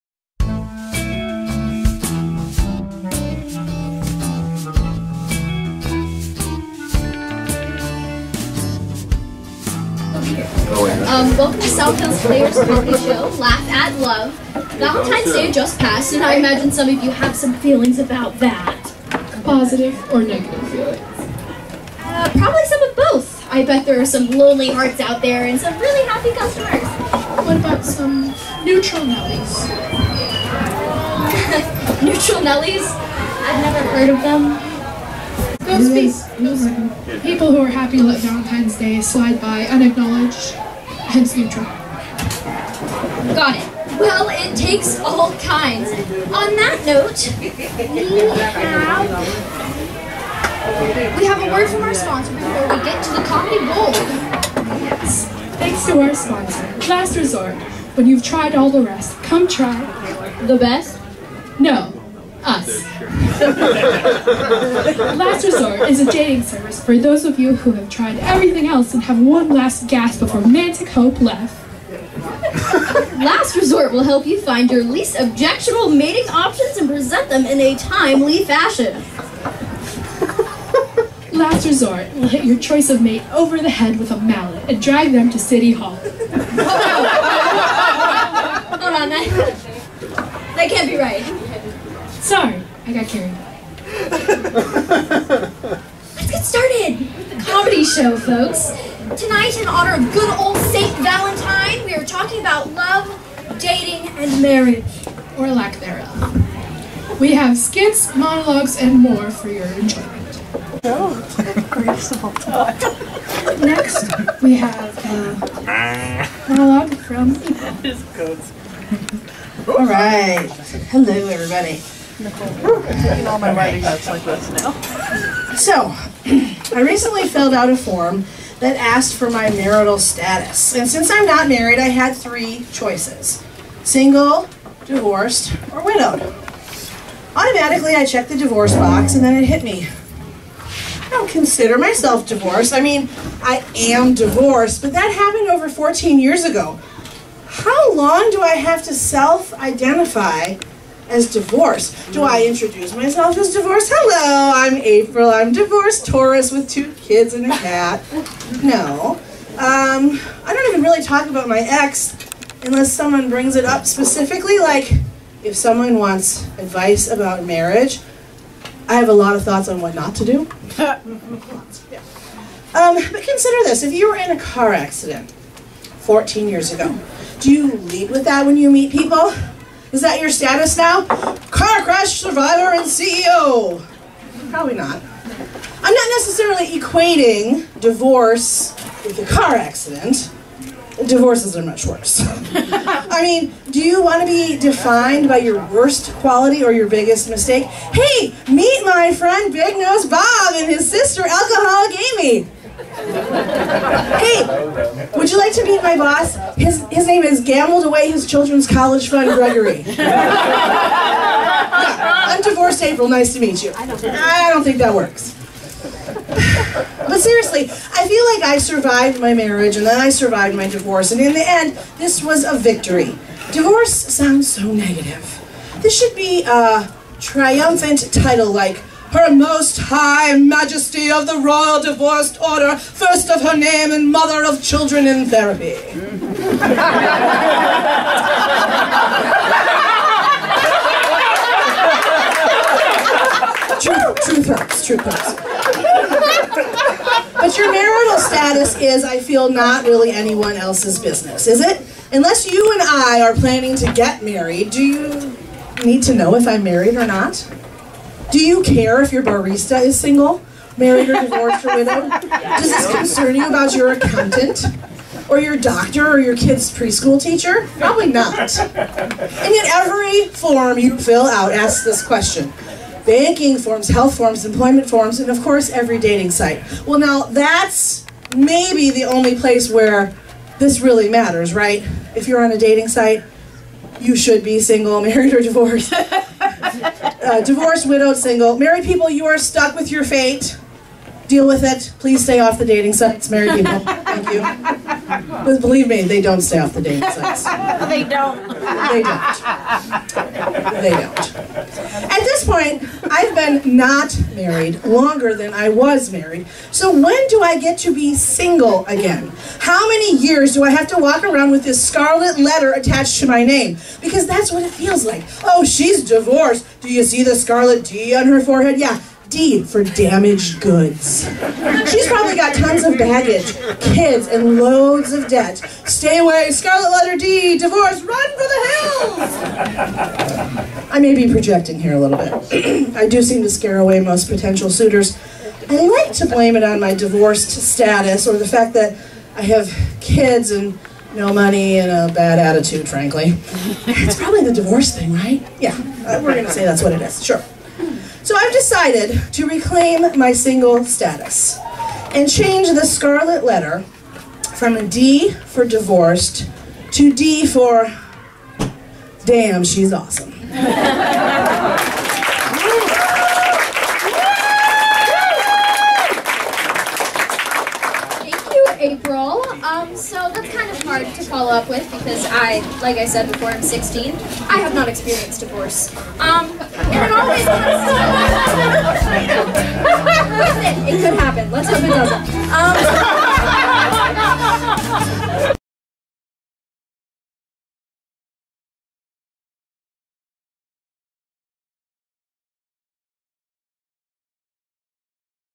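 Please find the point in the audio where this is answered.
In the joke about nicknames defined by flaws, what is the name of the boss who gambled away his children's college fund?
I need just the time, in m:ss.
3:29.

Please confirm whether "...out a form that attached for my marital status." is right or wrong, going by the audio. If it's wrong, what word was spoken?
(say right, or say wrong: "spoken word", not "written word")
wrong: "asked", not "attached".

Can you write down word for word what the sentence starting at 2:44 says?
Like, if someone wants advice about marriage, I have a lot of thoughts on what not to do.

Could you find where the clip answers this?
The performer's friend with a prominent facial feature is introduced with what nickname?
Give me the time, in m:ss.
3:19.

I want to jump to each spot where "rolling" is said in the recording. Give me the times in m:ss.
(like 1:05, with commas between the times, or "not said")
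not said.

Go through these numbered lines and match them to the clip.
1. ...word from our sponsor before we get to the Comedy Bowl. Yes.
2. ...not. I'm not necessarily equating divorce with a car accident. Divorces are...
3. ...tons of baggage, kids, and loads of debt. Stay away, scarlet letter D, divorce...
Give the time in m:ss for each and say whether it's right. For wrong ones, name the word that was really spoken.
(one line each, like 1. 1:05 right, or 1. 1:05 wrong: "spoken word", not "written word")
1. 0:51 right
2. 3:04 right
3. 5:22 right.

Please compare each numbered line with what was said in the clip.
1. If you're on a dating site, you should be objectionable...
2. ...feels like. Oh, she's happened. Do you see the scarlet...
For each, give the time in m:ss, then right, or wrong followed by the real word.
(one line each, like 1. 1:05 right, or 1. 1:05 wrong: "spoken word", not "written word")
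1. 4:42 wrong: "single", not "objectionable"
2. 5:14 wrong: "divorced", not "happened".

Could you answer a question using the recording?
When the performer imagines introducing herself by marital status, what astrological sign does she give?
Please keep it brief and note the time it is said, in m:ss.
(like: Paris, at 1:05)
Taurus, at 2:36.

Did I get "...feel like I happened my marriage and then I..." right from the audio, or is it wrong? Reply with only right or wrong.
wrong.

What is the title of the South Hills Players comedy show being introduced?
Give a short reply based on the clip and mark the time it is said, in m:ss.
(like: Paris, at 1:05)
Laugh at Love, at 0:13.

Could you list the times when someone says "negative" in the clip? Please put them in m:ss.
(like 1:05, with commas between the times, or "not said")
0:20, 3:44.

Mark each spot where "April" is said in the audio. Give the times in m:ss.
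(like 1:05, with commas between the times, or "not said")
2:34, 3:32, 6:08.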